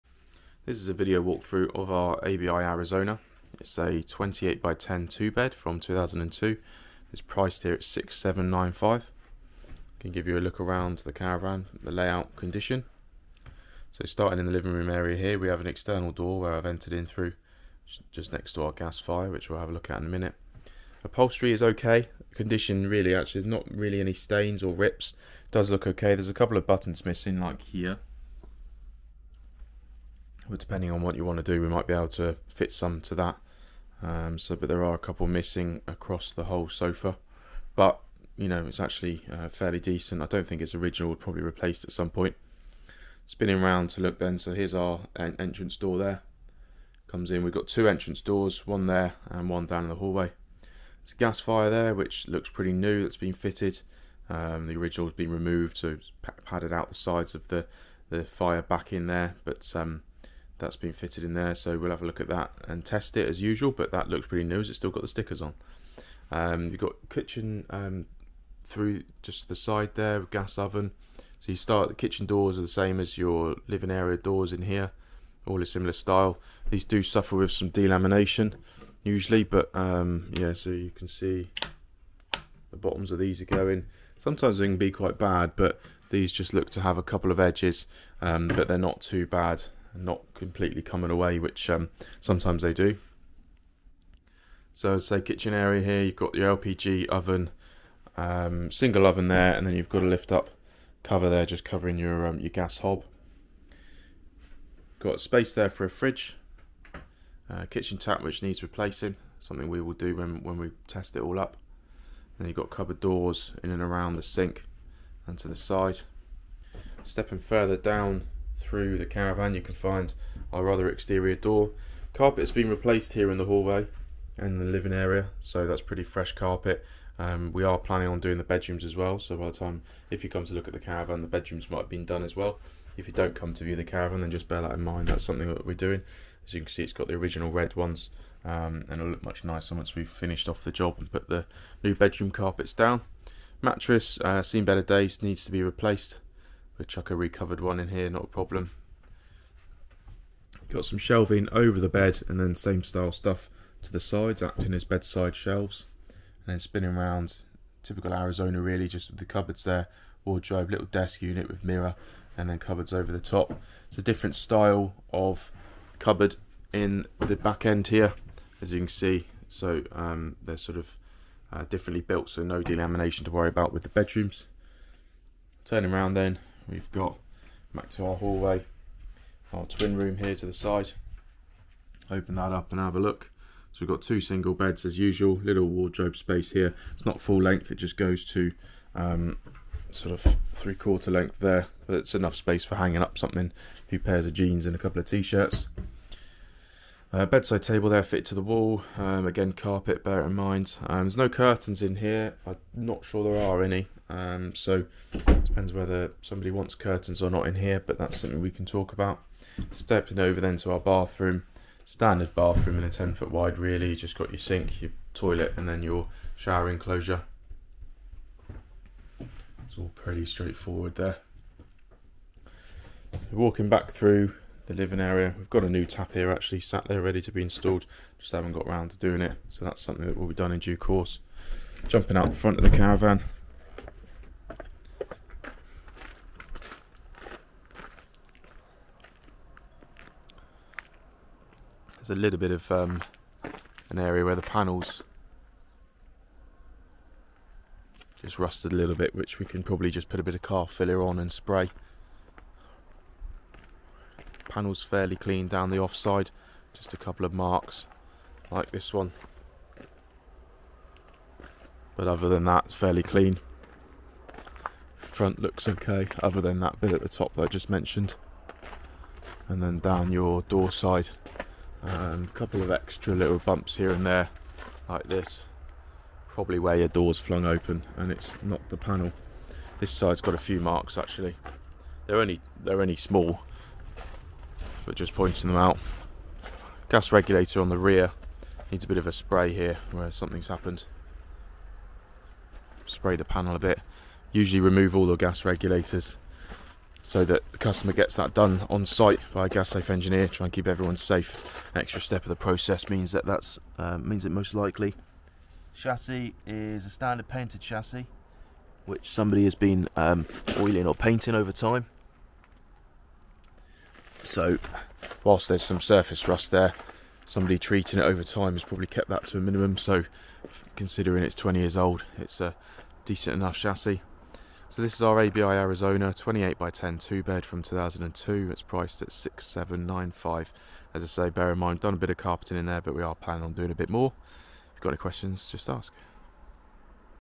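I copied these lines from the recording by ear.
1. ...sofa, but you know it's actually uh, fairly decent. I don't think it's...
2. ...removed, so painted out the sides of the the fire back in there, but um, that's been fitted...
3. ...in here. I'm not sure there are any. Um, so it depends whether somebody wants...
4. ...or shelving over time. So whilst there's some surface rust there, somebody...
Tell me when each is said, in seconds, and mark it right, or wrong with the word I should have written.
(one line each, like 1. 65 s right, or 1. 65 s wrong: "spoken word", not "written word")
1. 36 s right
2. 55 s wrong: "padded", not "painted"
3. 201 s right
4. 310 s wrong: "painting", not "shelving".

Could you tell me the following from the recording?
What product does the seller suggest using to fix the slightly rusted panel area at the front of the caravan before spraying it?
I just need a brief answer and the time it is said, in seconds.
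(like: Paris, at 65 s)
Car filler, at 250 s.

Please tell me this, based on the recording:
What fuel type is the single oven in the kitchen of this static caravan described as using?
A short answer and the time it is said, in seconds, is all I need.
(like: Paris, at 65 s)
LPG, at 96 s.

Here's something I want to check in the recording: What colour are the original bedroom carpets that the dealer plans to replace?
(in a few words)
Red.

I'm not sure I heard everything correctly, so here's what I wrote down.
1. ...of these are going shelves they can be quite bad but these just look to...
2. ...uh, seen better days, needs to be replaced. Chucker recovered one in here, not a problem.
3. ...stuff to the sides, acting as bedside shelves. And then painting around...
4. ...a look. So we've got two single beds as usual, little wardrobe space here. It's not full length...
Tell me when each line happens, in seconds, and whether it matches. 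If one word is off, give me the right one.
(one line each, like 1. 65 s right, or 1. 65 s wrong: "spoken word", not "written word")
1. 83 s wrong: "sometimes", not "shelves"
2. 144 s right
3. 153 s wrong: "spinning", not "painting"
4. 182 s right.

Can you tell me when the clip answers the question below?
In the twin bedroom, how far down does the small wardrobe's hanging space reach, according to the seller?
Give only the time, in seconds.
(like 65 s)
190 s.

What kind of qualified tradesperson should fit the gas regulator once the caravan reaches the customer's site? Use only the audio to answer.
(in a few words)
Gas safe engineer.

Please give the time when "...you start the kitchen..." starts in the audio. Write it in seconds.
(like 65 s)
71 s.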